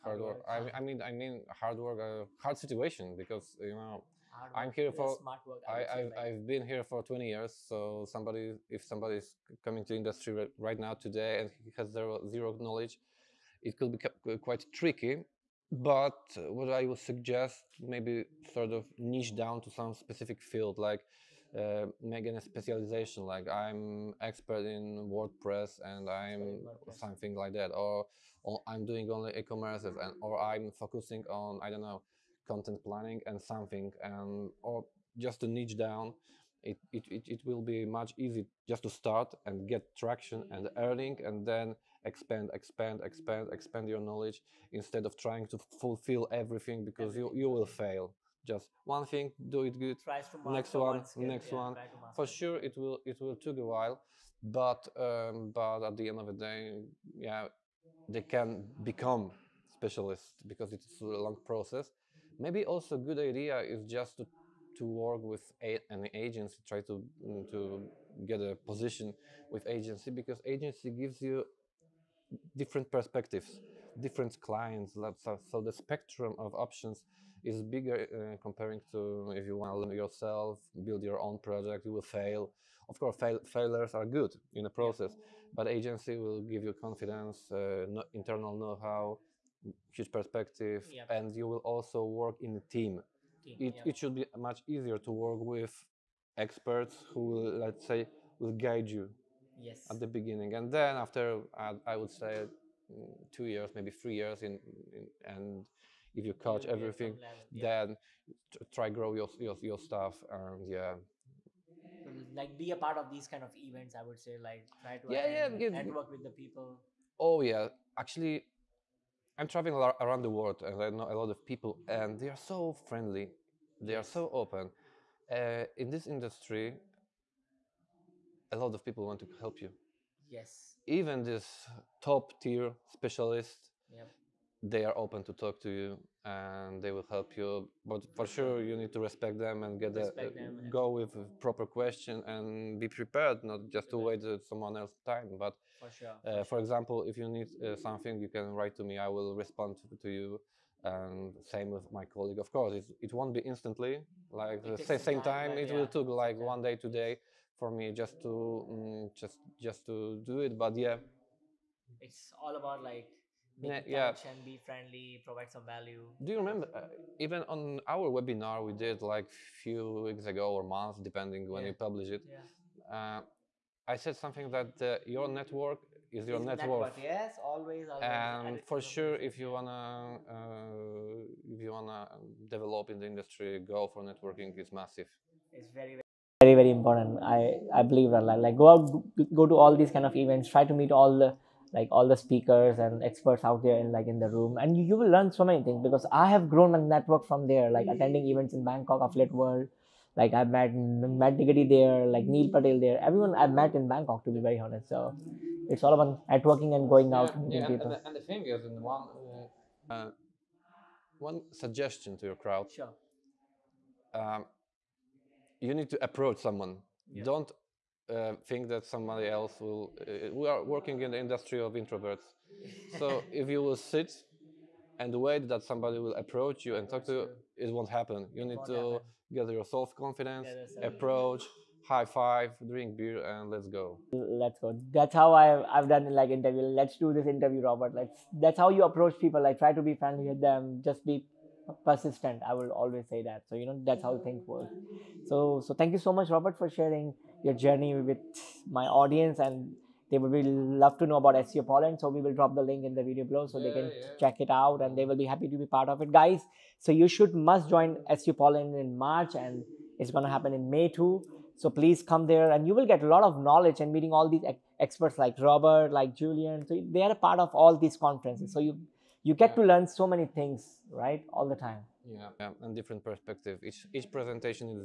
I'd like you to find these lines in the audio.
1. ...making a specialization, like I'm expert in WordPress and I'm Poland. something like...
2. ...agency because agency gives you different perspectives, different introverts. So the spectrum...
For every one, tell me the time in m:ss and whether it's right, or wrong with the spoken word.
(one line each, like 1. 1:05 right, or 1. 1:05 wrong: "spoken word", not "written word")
1. 0:22 wrong: "WordPress", not "Poland"
2. 1:09 wrong: "clients", not "introverts".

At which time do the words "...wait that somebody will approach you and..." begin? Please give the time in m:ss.
3:45.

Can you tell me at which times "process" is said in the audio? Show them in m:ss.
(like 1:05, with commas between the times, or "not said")
1:01, 1:24.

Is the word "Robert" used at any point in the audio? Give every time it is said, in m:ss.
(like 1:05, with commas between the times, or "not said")
3:57, 4:06, 4:25.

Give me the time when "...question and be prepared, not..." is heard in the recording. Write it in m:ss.
2:21.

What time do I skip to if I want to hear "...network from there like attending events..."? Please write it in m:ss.
3:16.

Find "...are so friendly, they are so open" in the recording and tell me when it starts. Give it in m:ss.
2:02.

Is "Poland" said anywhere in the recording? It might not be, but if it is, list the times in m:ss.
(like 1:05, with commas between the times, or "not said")
4:11, 4:18.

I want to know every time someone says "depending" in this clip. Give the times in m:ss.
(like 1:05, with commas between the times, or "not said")
2:50.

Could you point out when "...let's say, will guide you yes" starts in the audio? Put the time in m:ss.
1:37.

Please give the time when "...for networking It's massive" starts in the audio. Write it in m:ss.
3:03.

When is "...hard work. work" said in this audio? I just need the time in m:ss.
0:00.